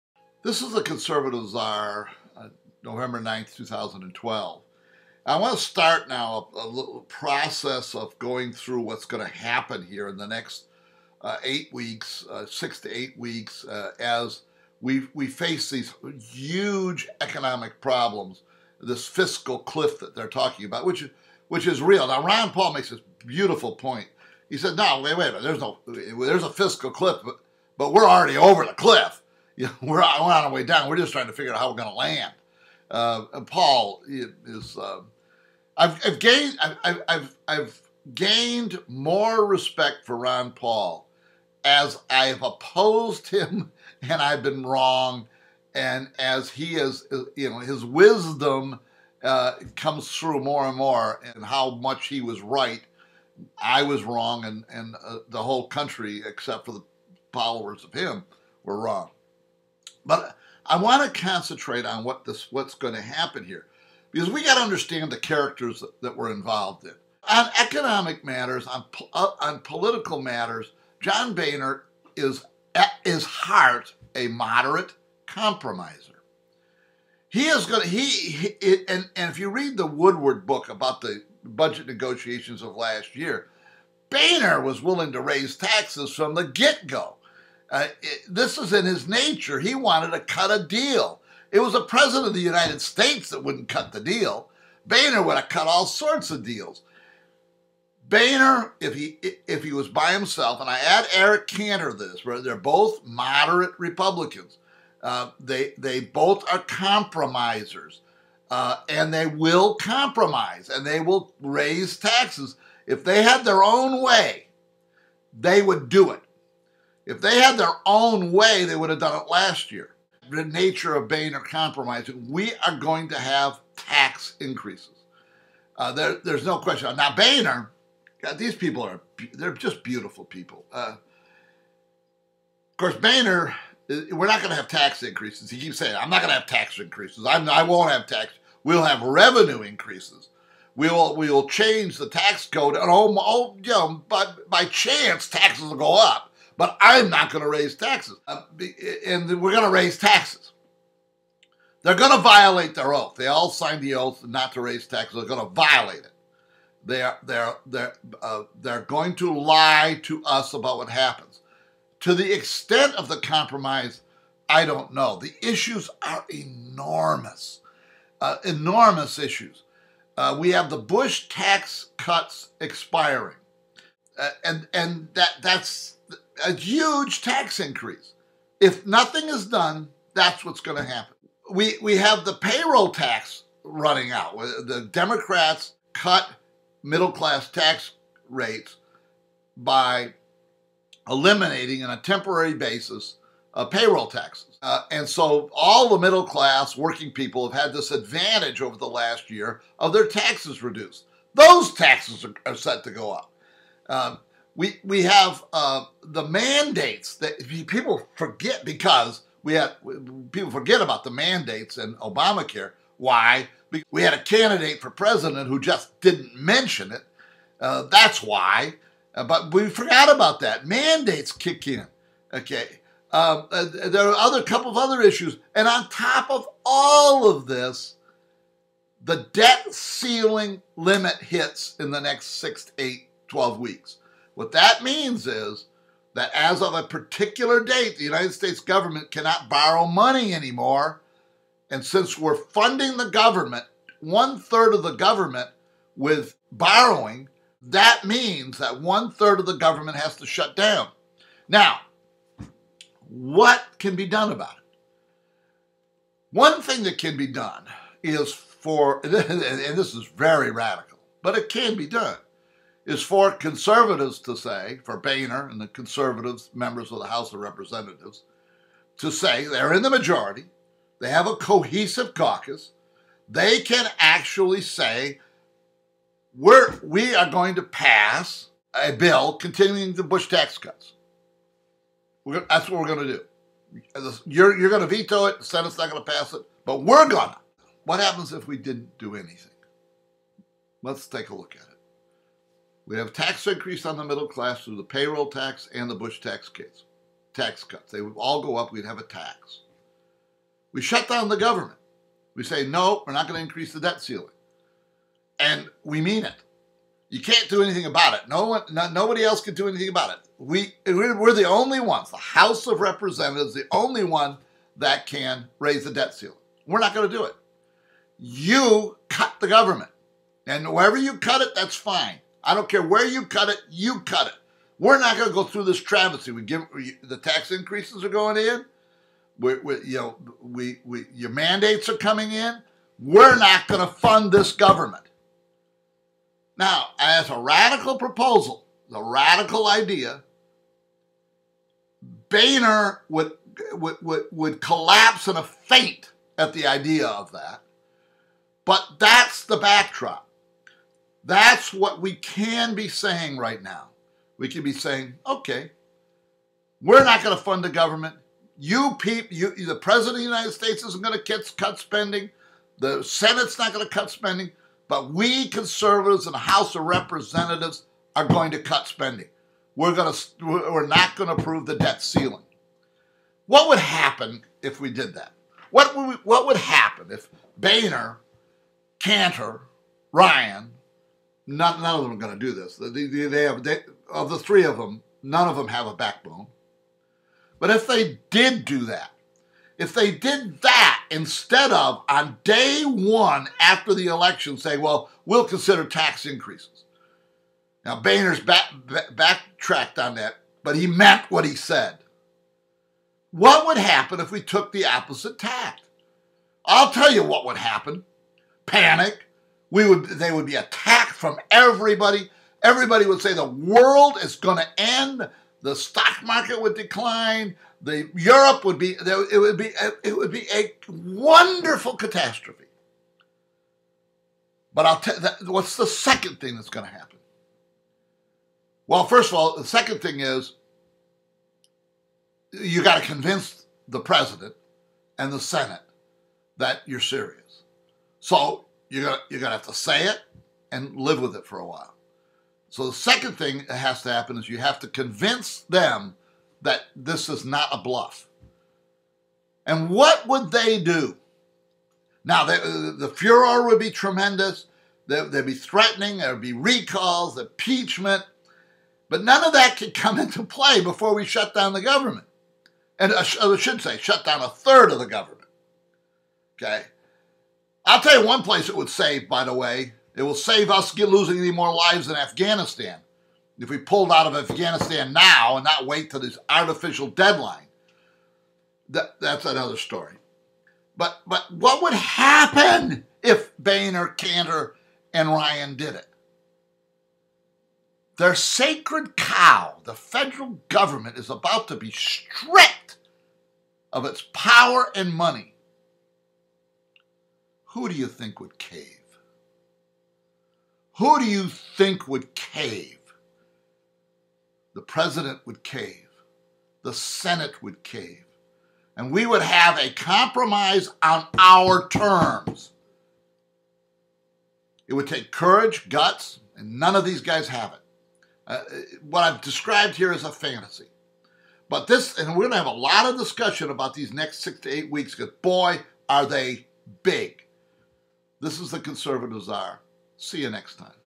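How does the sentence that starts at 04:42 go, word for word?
We're, that's what we're going to do.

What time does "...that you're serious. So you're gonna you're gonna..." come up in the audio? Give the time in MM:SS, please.
07:16.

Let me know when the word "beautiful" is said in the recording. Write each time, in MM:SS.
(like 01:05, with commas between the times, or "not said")
00:23, 02:09.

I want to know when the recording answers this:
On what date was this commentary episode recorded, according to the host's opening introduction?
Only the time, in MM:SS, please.
00:02.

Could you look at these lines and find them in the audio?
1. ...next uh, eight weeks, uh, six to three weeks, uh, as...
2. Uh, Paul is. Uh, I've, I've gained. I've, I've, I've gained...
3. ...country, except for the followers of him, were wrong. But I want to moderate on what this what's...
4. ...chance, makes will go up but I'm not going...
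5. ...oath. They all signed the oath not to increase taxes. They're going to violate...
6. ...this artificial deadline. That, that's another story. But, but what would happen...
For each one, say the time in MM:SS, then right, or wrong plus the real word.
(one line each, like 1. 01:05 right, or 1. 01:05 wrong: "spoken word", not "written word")
1. 00:10 wrong: "eight", not "three"
2. 00:32 right
3. 00:55 wrong: "concentrate", not "moderate"
4. 02:24 wrong: "taxes", not "makes"
5. 02:32 wrong: "raise", not "increase"
6. 07:56 right.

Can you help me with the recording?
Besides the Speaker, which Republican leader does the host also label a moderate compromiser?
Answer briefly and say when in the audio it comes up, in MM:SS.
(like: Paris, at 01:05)
Eric Cantor, at 01:41.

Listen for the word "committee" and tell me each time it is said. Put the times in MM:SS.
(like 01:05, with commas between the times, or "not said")
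not said.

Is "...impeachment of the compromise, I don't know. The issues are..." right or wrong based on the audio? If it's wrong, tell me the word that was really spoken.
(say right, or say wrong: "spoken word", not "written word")
wrong: "extent", not "impeachment".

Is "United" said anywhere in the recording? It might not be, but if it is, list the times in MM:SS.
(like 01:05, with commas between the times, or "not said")
01:32, 03:58, 06:00.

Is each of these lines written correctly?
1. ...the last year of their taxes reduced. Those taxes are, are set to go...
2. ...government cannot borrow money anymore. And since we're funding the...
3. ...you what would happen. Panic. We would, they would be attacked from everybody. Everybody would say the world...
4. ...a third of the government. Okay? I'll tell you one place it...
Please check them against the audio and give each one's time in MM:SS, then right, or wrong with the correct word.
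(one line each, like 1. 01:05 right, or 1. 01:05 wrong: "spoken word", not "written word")
1. 03:18 right
2. 03:58 right
3. 06:47 right
4. 07:44 right.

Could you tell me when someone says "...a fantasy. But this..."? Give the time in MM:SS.
08:40.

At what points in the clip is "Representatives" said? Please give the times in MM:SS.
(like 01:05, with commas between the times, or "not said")
04:27, 05:12, 06:06.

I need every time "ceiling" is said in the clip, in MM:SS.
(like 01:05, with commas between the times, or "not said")
03:49, 05:04, 05:16, 06:12.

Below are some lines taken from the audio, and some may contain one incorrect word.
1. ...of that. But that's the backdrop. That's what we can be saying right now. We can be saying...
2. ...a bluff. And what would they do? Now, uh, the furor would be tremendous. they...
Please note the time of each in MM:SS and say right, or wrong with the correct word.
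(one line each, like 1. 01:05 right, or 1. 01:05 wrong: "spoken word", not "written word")
1. 05:47 right
2. 07:27 right.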